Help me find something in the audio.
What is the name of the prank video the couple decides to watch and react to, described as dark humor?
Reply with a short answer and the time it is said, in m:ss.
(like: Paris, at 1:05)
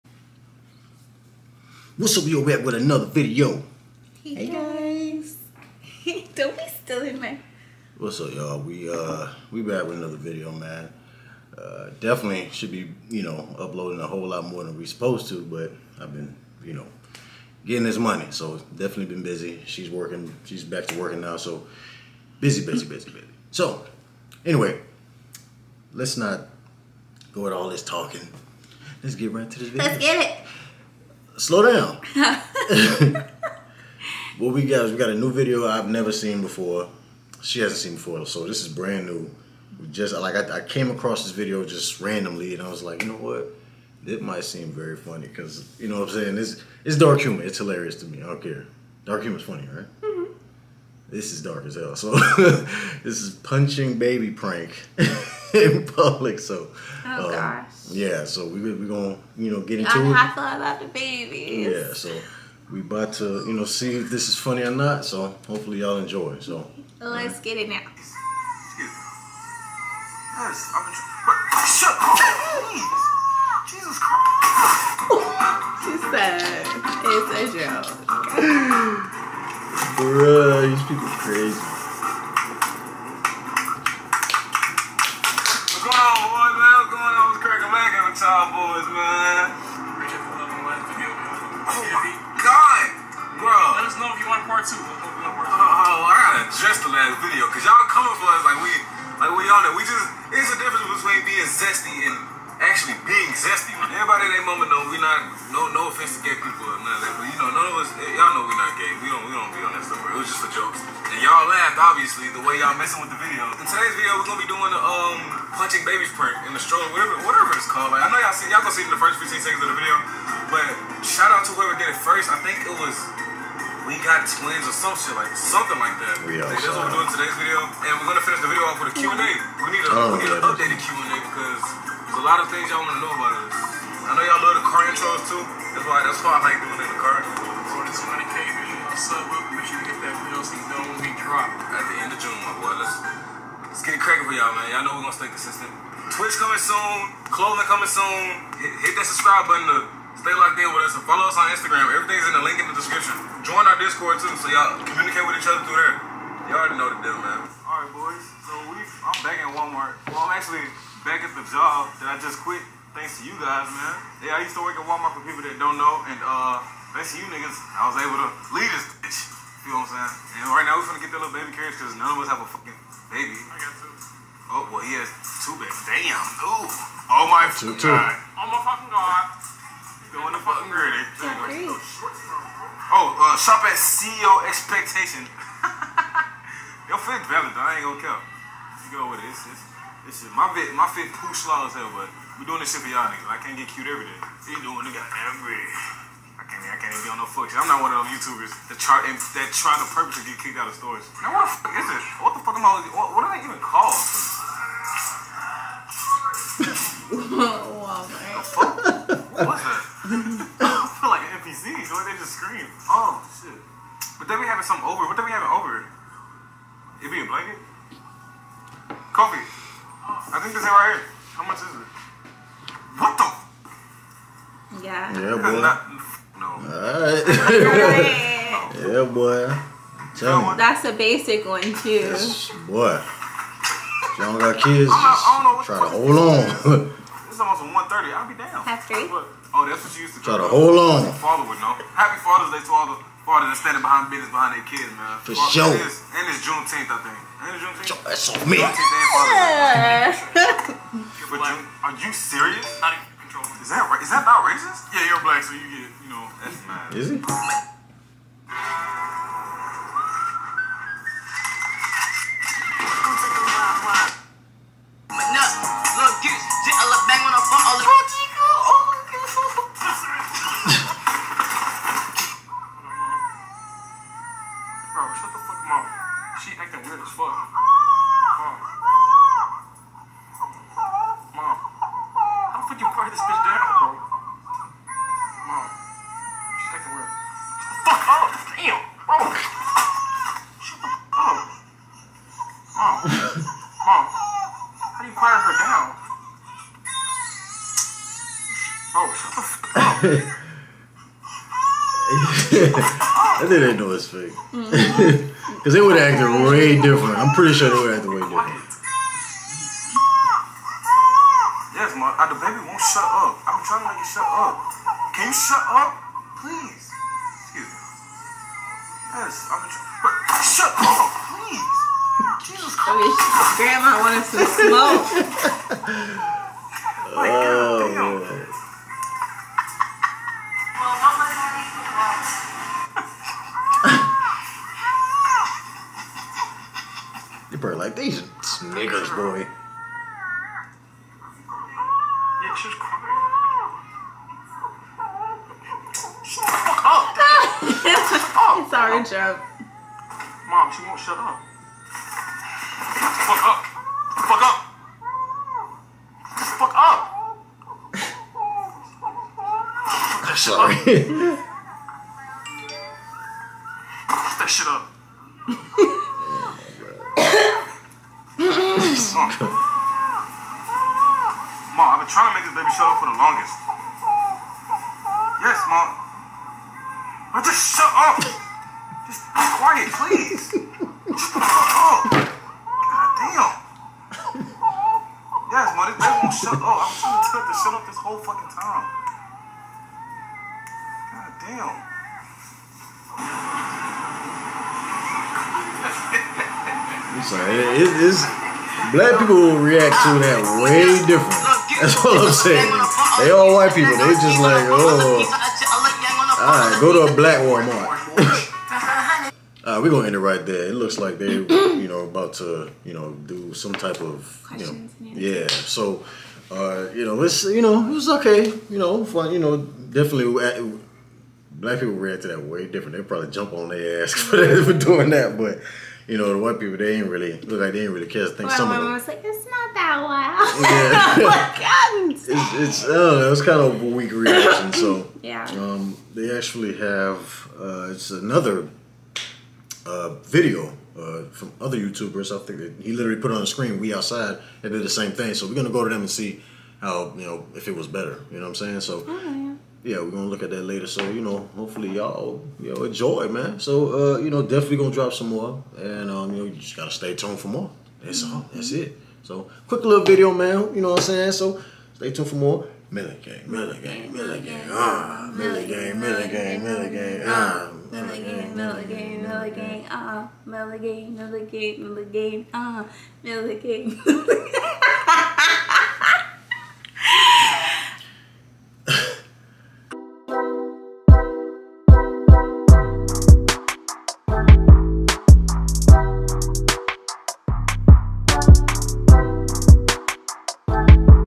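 Punching baby prank, at 0:53.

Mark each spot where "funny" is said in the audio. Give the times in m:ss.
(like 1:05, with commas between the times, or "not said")
0:44, 0:49, 1:04.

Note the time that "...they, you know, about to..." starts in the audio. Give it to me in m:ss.
6:51.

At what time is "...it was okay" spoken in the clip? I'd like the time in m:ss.
6:57.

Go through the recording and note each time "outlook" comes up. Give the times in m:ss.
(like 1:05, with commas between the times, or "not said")
not said.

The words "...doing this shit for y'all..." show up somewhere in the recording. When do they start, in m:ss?
3:12.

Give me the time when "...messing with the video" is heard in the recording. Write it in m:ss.
1:52.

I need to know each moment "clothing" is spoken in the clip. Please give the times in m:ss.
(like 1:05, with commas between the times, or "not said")
2:27.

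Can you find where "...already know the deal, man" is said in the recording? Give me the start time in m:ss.
2:36.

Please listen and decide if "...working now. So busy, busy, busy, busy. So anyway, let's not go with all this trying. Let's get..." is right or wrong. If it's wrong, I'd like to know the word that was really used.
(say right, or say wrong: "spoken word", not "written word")
wrong: "talking", not "trying".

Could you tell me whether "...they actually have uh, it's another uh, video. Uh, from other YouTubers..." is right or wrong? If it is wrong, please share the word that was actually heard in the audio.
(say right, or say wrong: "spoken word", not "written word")
right.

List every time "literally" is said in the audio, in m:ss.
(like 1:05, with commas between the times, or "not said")
7:22.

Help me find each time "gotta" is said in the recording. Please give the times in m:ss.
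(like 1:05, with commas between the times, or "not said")
1:36, 7:36.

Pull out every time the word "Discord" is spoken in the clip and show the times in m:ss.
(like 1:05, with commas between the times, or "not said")
2:33.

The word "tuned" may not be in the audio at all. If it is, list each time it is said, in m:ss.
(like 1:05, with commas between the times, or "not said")
7:37, 7:42.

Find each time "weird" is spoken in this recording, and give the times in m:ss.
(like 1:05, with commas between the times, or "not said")
4:36, 4:46.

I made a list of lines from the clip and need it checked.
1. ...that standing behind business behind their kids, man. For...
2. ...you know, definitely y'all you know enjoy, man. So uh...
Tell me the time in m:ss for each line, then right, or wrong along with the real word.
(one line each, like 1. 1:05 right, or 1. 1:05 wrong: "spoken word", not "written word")
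1. 4:03 right
2. 7:31 wrong: "hopefully", not "definitely".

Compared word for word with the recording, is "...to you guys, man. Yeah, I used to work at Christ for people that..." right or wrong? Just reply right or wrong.
wrong.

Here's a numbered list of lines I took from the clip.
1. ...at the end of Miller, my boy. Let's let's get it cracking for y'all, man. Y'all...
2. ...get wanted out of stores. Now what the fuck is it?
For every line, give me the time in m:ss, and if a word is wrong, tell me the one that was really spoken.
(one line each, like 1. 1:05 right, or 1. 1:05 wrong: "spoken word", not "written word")
1. 2:21 wrong: "June", not "Miller"
2. 3:20 wrong: "kicked", not "wanted".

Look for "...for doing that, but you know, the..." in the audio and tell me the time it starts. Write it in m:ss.
7:04.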